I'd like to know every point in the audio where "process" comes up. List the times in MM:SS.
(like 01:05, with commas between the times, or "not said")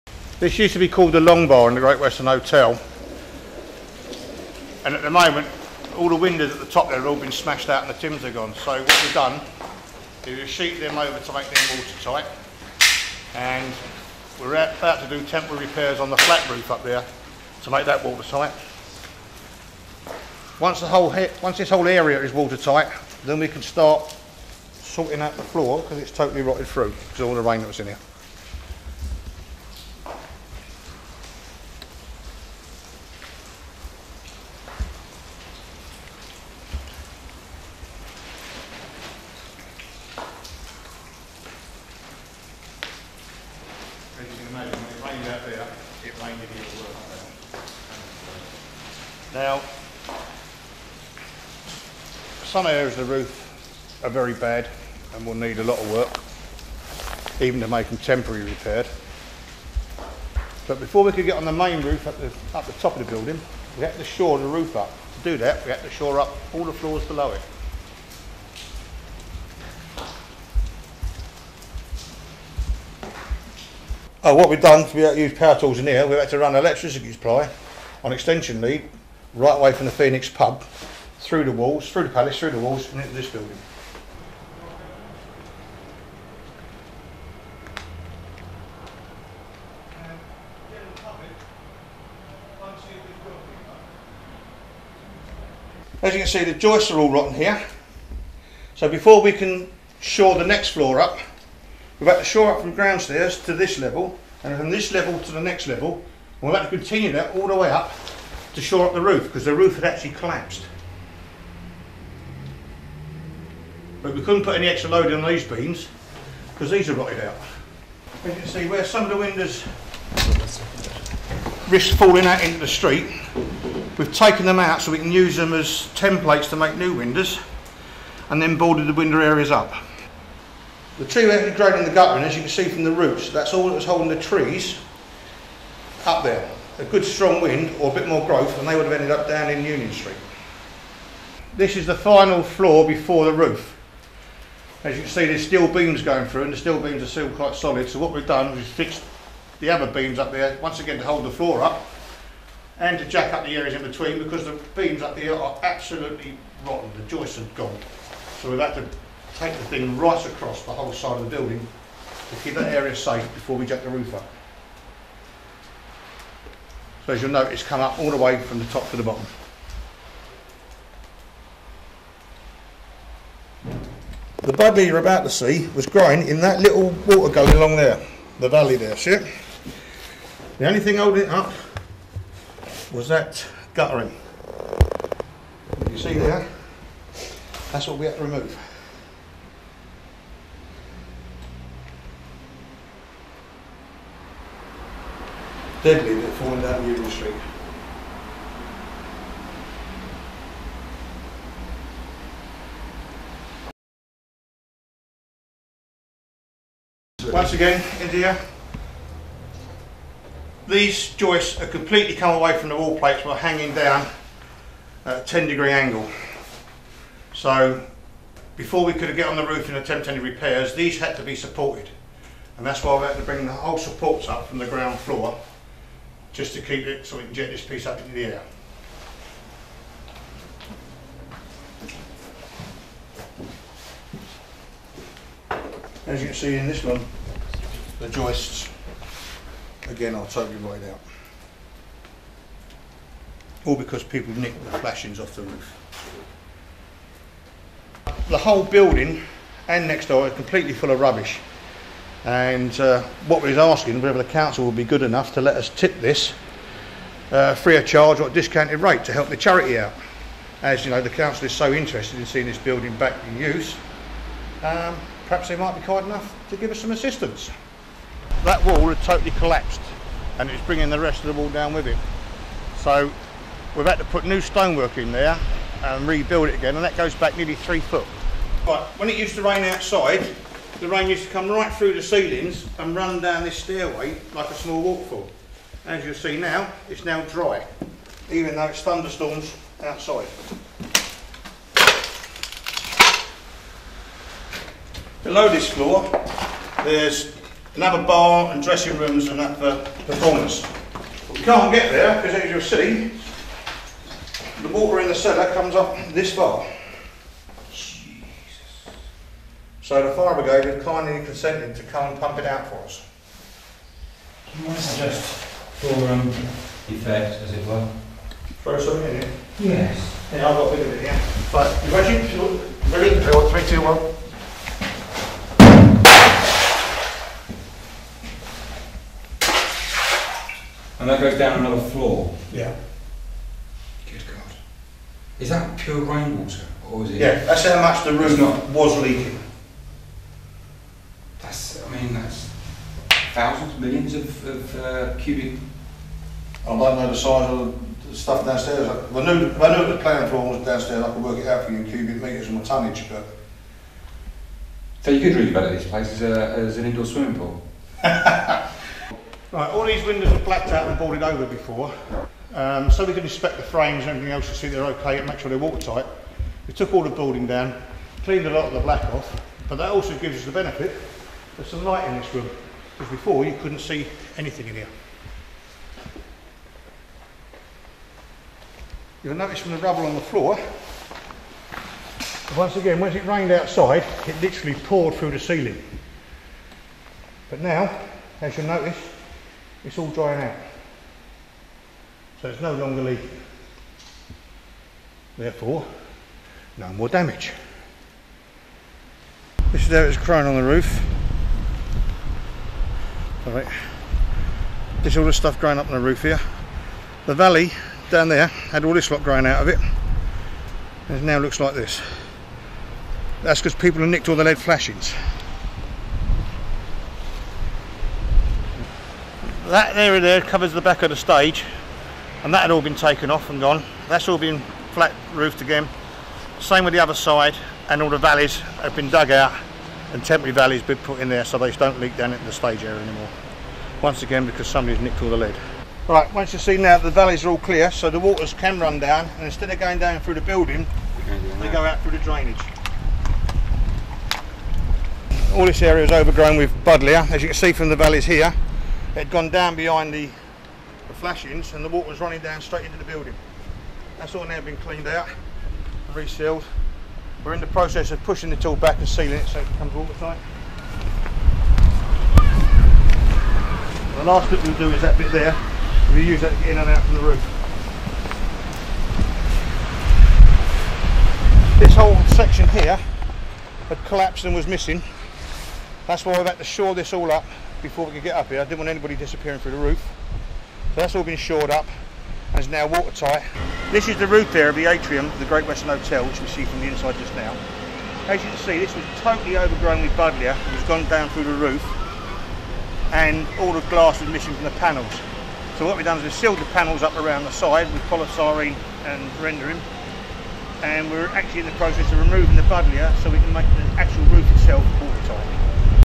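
07:37, 08:21.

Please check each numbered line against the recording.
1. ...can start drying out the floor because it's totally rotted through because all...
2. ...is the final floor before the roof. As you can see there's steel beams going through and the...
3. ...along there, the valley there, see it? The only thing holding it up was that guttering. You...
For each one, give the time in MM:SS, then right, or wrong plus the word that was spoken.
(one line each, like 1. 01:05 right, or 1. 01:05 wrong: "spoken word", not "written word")
1. 00:23 wrong: "sorting", not "drying"
2. 02:21 right
3. 02:57 right.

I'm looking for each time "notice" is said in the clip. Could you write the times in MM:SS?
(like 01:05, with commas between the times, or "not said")
06:19, 06:28.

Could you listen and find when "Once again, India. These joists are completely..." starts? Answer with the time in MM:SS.
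03:27.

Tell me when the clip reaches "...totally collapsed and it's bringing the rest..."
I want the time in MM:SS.
04:29.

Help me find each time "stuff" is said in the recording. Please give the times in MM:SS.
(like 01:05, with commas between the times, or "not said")
05:48, 06:45.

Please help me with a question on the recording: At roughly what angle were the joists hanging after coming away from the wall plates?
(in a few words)
10 degrees.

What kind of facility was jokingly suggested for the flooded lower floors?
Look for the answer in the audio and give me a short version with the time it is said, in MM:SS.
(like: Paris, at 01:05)
indoor swimming pool, at 05:56.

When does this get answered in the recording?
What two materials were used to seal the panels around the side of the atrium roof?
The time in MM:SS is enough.
08:18.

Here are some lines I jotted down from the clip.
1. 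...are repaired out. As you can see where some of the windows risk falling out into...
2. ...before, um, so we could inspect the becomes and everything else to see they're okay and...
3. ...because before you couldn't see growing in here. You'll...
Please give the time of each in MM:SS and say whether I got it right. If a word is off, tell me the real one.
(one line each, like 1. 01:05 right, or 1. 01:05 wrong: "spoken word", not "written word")
1. 01:56 wrong: "rotted", not "repaired"
2. 06:01 wrong: "frames", not "becomes"
3. 06:12 wrong: "anything", not "growing".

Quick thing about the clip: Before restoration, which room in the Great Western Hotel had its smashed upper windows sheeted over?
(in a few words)
Long Bar.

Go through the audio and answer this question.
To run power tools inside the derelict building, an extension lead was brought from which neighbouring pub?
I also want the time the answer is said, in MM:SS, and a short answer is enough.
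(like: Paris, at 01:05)
Phoenix, at 01:19.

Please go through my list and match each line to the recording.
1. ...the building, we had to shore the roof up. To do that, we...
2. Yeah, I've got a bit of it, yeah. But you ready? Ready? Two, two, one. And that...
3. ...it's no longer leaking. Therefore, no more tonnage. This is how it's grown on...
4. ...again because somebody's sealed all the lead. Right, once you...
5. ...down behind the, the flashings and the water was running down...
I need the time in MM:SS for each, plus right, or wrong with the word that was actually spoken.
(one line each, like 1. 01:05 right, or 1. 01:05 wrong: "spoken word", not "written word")
1. 01:03 right
2. 05:20 wrong: "Three", not "Two"
3. 06:32 wrong: "damage", not "tonnage"
4. 07:14 wrong: "nicked", not "sealed"
5. 07:29 right.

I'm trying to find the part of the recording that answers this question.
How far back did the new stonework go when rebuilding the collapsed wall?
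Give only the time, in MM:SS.
04:37.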